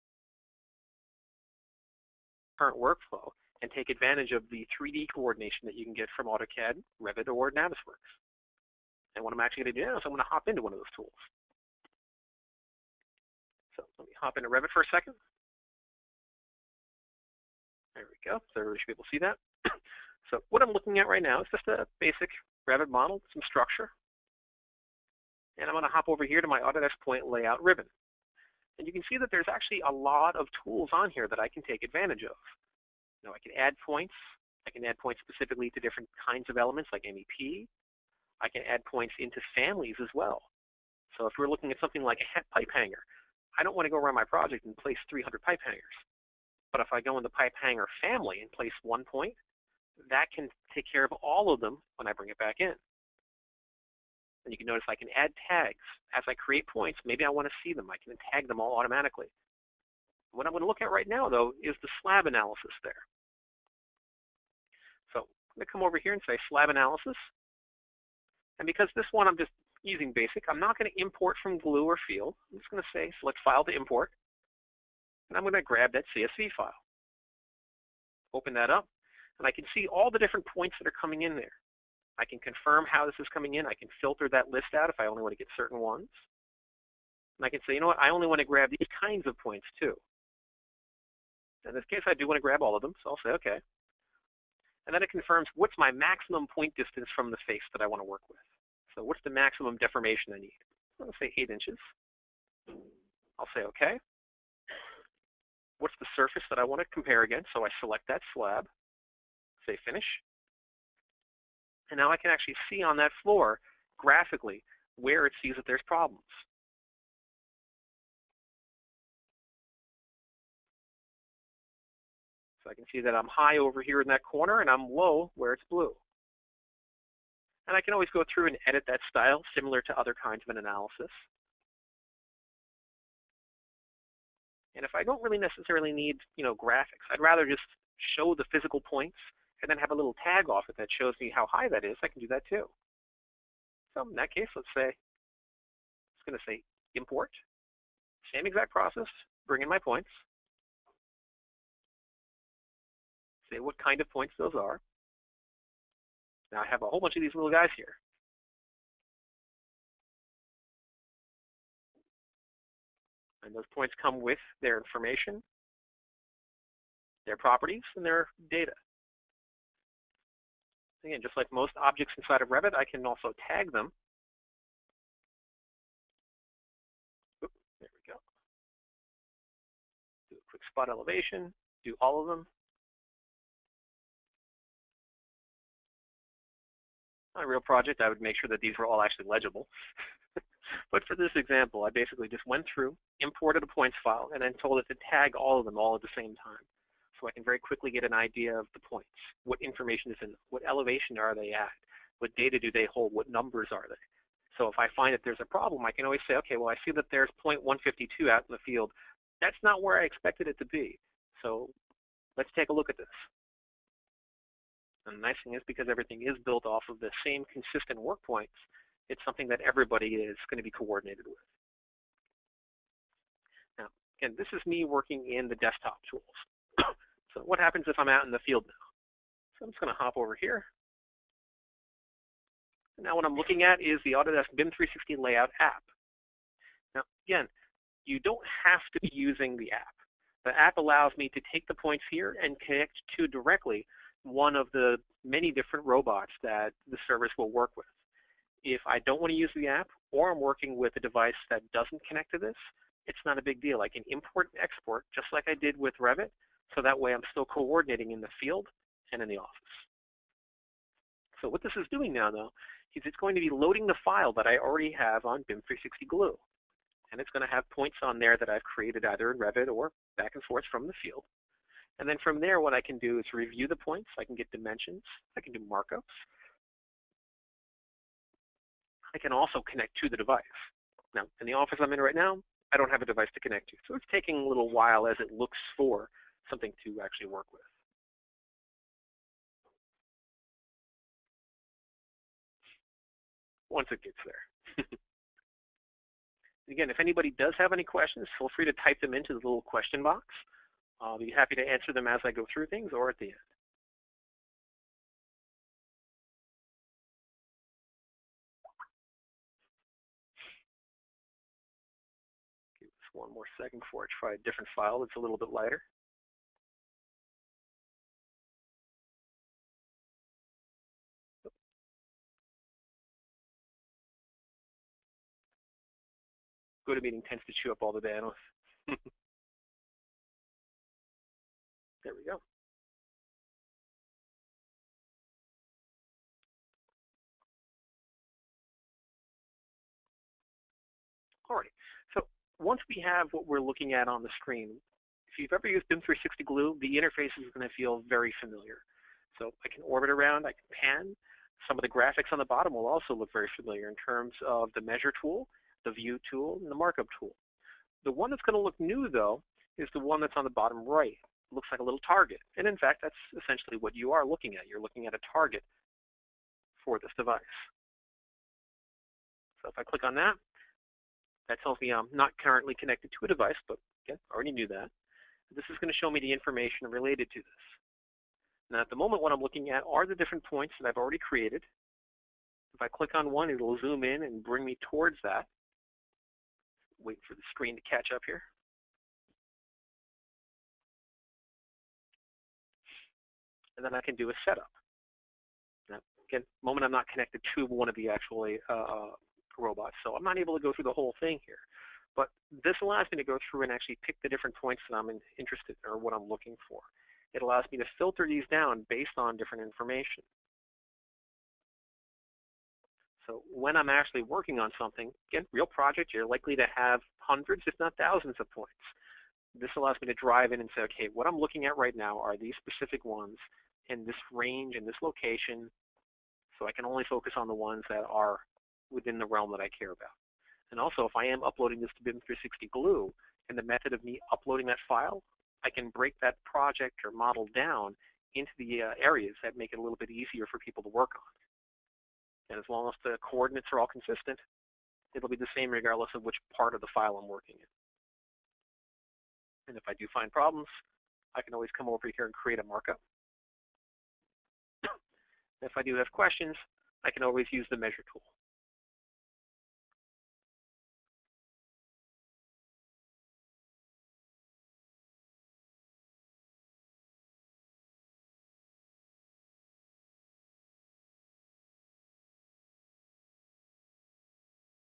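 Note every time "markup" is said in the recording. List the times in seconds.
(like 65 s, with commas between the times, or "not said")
275 s, 356 s, 452 s.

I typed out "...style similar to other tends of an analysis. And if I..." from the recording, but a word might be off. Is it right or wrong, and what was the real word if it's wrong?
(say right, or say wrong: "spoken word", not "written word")
wrong: "kinds", not "tends".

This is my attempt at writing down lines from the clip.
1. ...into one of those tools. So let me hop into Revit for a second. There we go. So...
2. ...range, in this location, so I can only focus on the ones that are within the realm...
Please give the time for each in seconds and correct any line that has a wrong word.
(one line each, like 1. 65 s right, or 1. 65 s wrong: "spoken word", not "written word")
1. 10 s right
2. 424 s right.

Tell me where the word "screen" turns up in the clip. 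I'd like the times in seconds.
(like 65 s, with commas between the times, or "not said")
344 s, 387 s.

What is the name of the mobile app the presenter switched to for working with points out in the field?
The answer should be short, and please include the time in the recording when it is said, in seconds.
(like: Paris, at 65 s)
Autodesk BIM 360 Layout, at 234 s.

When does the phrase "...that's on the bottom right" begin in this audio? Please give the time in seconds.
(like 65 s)
360 s.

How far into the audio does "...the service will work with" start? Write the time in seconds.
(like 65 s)
246 s.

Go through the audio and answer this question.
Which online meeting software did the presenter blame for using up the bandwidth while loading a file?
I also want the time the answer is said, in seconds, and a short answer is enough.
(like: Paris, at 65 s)
GoToMeeting, at 326 s.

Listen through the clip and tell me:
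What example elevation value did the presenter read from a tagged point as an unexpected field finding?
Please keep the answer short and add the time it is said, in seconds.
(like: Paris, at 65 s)
0.152, at 207 s.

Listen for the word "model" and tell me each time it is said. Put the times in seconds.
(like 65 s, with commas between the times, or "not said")
22 s, 437 s.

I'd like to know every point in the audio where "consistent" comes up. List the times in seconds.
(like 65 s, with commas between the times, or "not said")
217 s, 443 s.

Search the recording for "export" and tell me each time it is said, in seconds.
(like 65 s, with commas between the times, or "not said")
254 s.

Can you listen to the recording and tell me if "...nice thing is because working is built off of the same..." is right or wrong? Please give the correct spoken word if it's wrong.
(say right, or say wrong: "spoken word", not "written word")
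wrong: "everything", not "working".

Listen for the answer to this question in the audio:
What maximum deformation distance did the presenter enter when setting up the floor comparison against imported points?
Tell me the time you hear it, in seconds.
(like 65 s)
101 s.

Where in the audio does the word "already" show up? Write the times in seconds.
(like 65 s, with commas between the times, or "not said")
264 s, 374 s, 380 s.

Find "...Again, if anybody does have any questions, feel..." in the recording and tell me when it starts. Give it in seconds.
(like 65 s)
296 s.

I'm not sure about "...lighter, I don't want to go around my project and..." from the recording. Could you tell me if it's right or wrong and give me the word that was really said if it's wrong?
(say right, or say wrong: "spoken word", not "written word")
wrong: "hanger", not "lighter".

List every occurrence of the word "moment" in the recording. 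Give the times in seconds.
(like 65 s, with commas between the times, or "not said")
378 s, 396 s.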